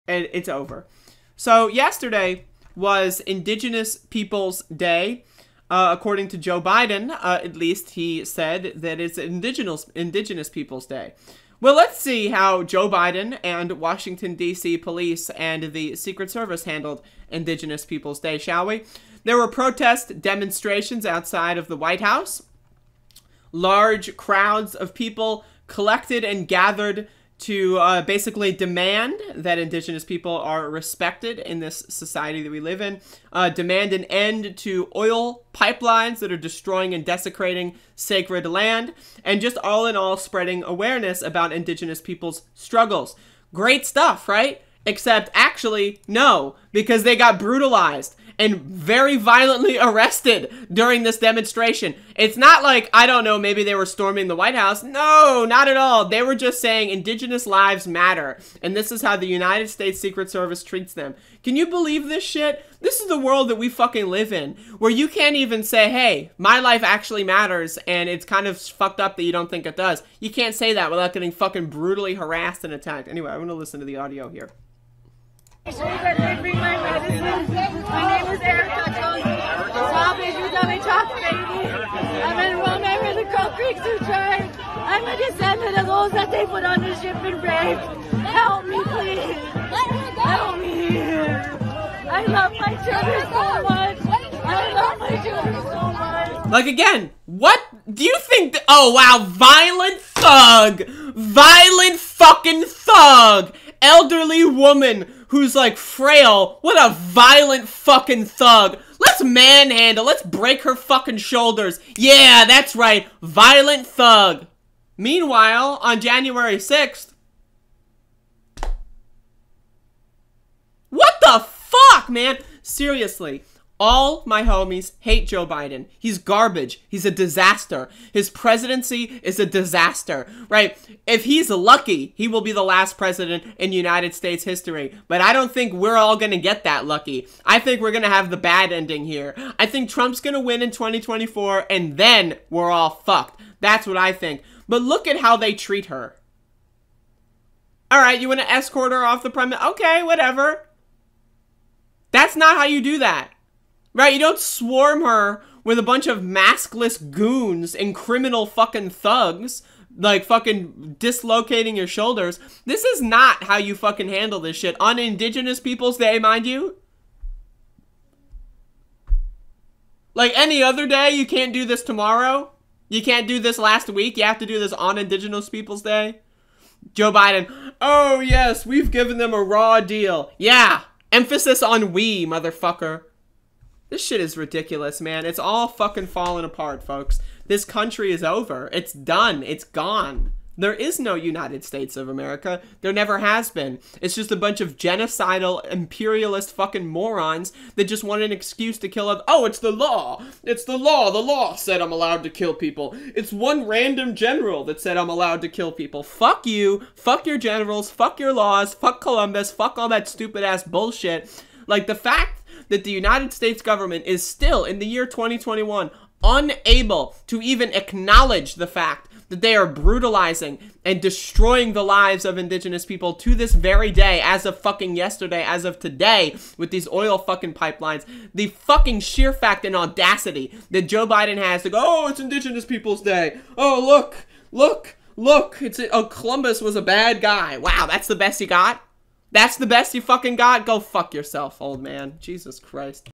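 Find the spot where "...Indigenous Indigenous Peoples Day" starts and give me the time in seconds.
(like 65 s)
9 s.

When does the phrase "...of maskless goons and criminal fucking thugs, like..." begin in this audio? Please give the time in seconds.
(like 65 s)
156 s.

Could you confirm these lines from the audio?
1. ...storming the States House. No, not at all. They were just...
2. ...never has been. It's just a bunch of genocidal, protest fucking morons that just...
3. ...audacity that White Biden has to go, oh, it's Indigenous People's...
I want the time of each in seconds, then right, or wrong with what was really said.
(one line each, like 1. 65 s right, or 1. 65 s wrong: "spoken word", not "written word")
1. 53 s wrong: "White", not "States"
2. 192 s wrong: "imperialist", not "protest"
3. 229 s wrong: "Joe", not "White".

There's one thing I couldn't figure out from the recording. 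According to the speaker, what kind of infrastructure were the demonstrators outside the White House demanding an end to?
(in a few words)
Oil pipelines.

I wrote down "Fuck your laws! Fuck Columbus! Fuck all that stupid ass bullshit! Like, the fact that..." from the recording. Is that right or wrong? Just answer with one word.
right.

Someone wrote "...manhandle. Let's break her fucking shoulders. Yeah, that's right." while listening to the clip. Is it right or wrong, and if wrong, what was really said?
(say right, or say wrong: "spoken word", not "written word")
right.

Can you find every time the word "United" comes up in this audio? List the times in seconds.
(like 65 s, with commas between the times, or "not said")
59 s, 133 s, 191 s, 212 s.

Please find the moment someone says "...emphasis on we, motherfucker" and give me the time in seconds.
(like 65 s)
181 s.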